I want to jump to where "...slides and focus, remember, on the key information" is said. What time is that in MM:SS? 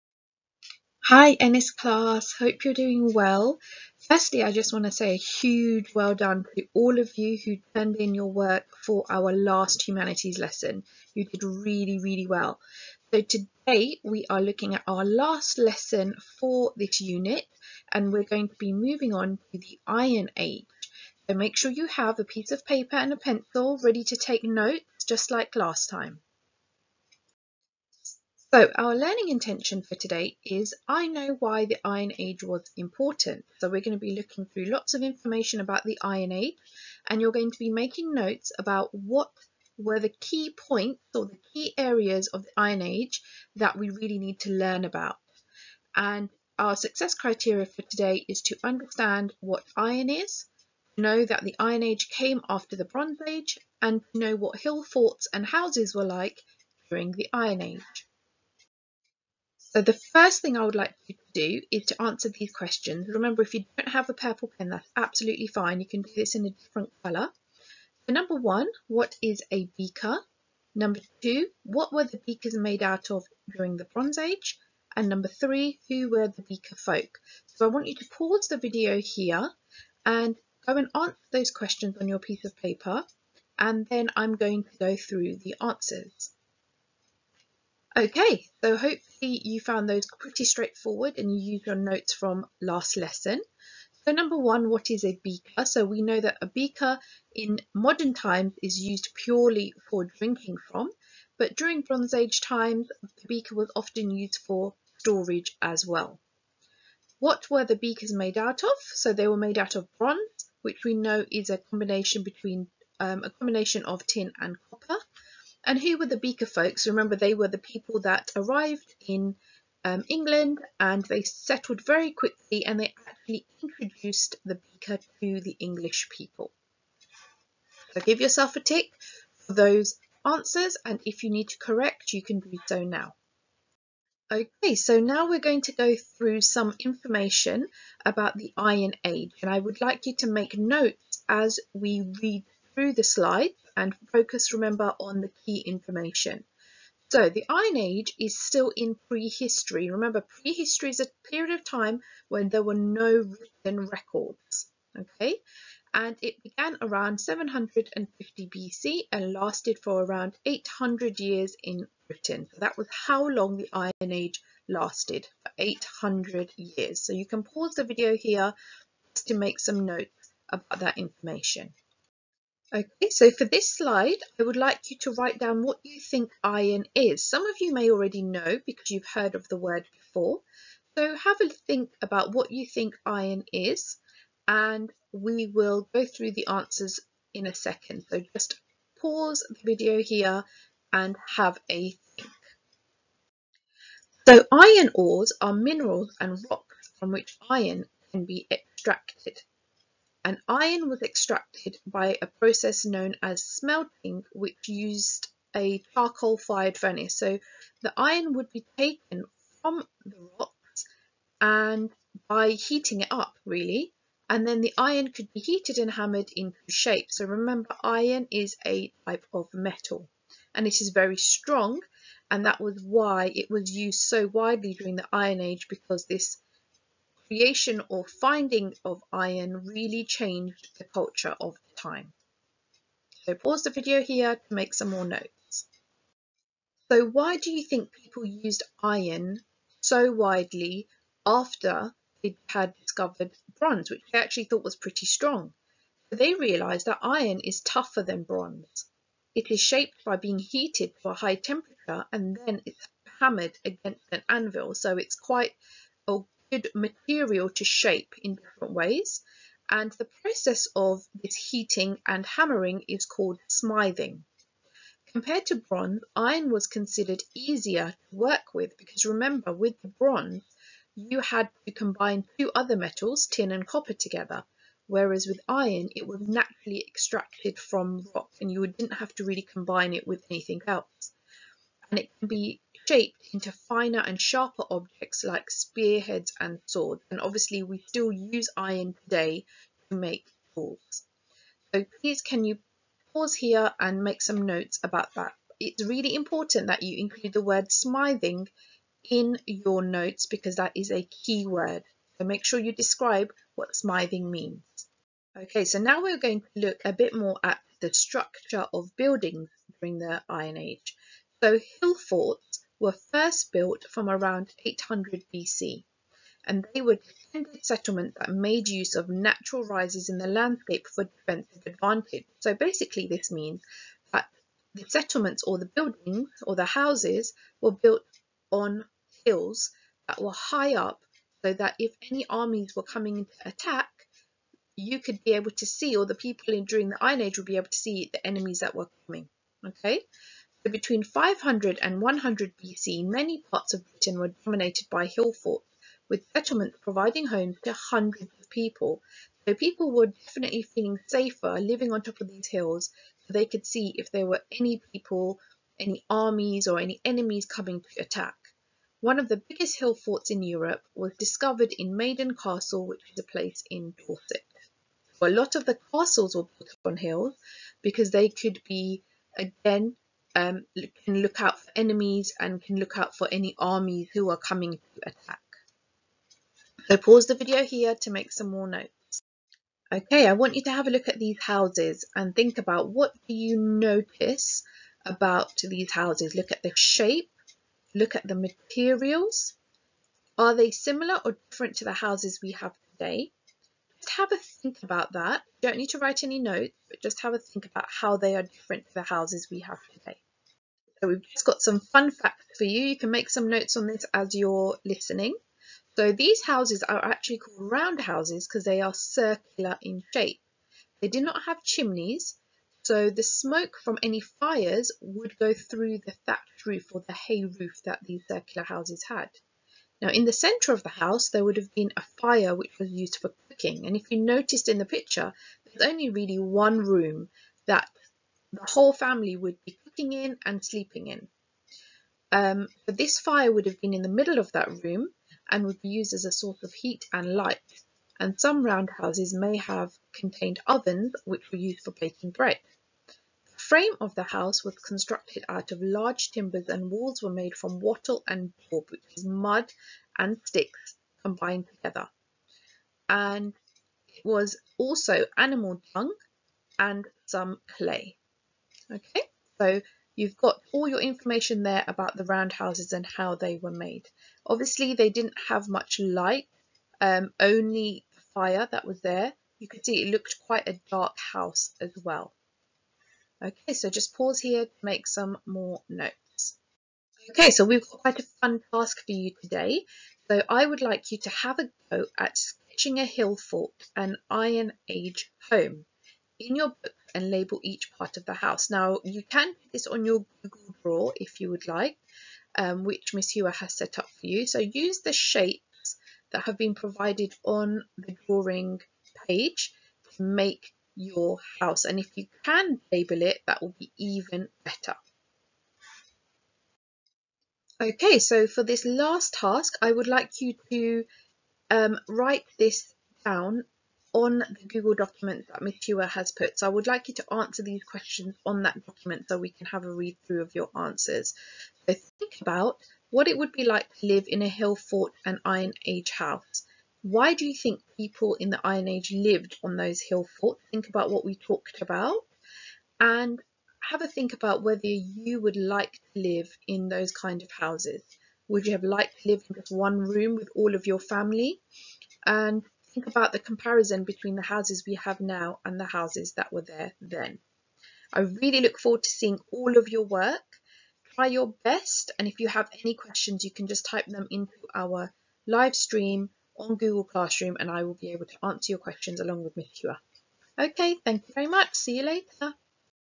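02:23.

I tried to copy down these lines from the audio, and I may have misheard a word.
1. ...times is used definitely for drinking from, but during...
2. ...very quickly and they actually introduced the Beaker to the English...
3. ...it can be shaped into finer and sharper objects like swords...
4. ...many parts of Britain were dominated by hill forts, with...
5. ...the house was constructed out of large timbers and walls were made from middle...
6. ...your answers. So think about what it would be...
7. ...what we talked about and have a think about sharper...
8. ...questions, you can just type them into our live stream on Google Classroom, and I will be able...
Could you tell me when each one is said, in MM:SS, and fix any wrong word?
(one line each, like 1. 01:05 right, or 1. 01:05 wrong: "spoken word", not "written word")
1. 01:38 wrong: "purely", not "definitely"
2. 02:01 right
3. 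04:41 wrong: "spearheads", not "swords"
4. 05:43 right
5. 07:24 wrong: "wattle", not "middle"
6. 08:40 right
7. 08:51 wrong: "whether", not "sharper"
8. 09:12 right.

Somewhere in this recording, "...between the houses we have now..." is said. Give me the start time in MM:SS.
09:04.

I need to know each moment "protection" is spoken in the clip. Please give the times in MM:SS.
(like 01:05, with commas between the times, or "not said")
not said.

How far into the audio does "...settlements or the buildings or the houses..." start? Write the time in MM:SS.
05:24.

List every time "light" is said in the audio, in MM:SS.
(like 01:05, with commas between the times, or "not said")
07:17, 07:45.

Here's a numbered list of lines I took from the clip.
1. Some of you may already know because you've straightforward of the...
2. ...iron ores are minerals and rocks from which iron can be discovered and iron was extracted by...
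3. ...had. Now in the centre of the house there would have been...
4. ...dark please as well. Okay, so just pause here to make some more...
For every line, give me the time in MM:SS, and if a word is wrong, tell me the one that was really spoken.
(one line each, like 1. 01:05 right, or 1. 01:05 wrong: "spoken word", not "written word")
1. 02:57 wrong: "heard", not "straightforward"
2. 03:14 wrong: "extracted", not "discovered"
3. 06:59 right
4. 07:50 wrong: "house", not "please".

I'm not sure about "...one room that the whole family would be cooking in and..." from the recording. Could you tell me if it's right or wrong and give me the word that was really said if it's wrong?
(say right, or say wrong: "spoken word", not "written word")
right.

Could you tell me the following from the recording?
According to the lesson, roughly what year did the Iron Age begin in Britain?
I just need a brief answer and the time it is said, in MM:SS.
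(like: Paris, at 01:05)
750 BC, at 02:37.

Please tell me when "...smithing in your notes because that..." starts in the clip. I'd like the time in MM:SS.
04:57.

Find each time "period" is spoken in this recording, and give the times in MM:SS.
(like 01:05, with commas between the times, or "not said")
02:31.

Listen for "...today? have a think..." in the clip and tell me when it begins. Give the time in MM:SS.
06:32.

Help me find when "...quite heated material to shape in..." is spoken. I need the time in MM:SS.
04:15.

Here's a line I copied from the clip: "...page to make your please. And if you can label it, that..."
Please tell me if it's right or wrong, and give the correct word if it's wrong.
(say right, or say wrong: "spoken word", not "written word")
wrong: "house", not "please".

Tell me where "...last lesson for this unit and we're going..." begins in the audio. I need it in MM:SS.
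00:15.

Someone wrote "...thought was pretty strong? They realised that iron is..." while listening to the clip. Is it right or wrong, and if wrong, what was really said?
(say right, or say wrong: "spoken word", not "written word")
right.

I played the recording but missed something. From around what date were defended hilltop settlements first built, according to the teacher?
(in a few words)
800 BC.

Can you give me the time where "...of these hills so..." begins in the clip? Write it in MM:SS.
05:52.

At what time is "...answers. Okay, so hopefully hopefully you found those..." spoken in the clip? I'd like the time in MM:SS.
01:25.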